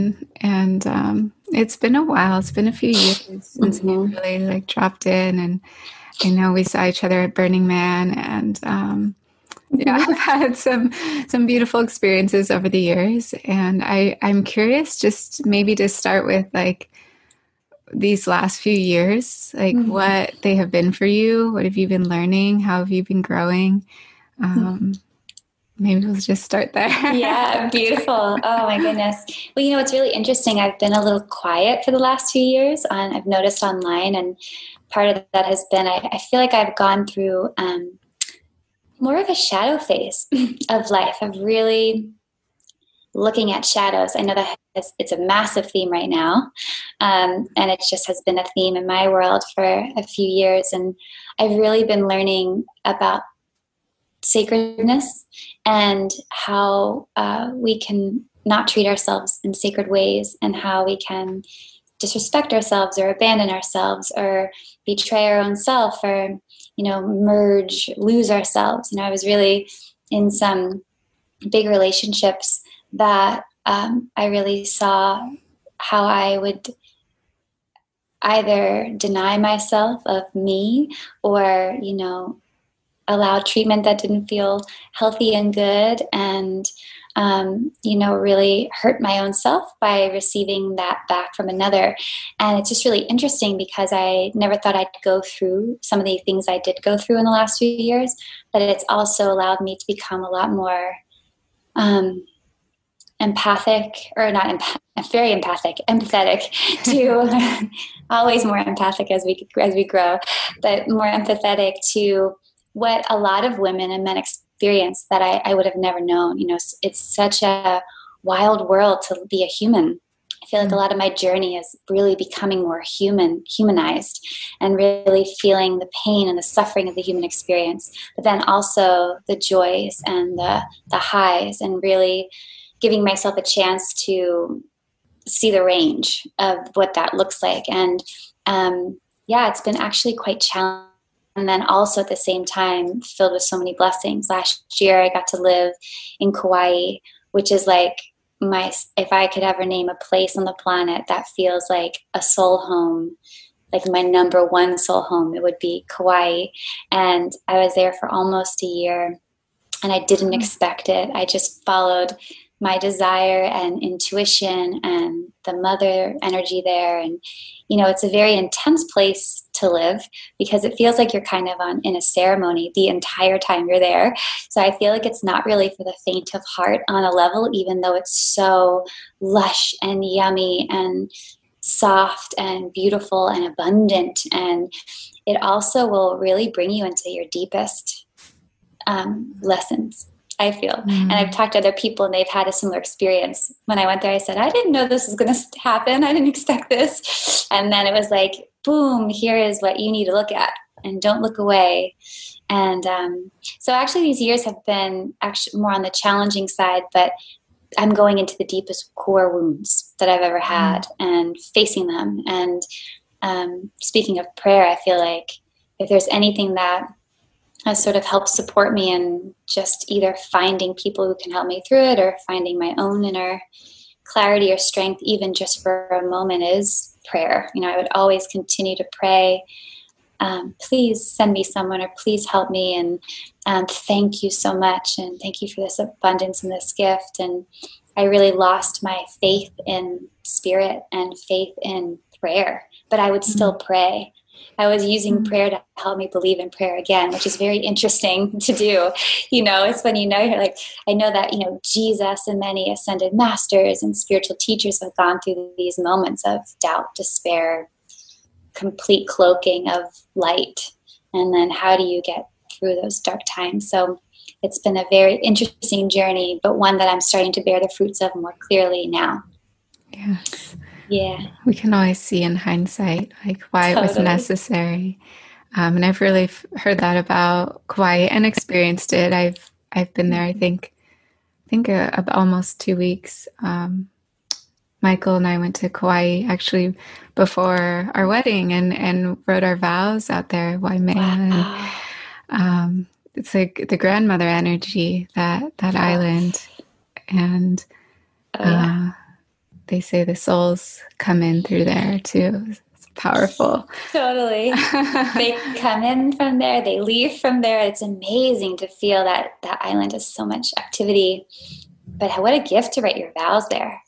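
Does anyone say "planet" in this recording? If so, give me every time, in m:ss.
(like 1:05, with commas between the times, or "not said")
2:30.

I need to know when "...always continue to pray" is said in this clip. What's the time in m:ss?
3:47.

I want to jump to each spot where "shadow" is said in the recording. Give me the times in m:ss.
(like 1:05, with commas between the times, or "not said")
0:39, 0:43.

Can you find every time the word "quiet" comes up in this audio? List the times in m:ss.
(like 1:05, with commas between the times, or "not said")
0:31.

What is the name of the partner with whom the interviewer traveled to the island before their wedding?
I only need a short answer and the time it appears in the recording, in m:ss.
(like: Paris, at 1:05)
Michael, at 4:44.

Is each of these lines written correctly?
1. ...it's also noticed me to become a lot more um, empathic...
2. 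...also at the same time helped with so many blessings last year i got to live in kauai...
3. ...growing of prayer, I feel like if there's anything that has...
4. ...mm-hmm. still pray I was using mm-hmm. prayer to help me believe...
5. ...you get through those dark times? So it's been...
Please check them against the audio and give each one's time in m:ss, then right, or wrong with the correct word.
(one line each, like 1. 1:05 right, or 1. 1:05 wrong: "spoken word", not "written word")
1. 1:38 wrong: "allowed", not "noticed"
2. 2:21 wrong: "filled", not "helped"
3. 3:33 wrong: "speaking", not "growing"
4. 4:03 right
5. 4:21 right.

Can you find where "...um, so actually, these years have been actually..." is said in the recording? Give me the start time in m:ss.
3:22.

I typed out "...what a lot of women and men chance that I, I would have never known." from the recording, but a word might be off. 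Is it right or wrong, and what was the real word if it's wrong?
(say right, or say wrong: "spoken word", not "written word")
wrong: "experience", not "chance".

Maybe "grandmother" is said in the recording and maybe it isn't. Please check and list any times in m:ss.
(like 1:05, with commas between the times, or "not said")
4:53.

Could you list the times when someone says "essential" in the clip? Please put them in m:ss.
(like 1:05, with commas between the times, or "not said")
not said.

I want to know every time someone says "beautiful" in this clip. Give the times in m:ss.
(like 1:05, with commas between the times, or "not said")
0:11, 0:27, 3:02.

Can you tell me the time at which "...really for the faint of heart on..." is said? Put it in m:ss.
2:55.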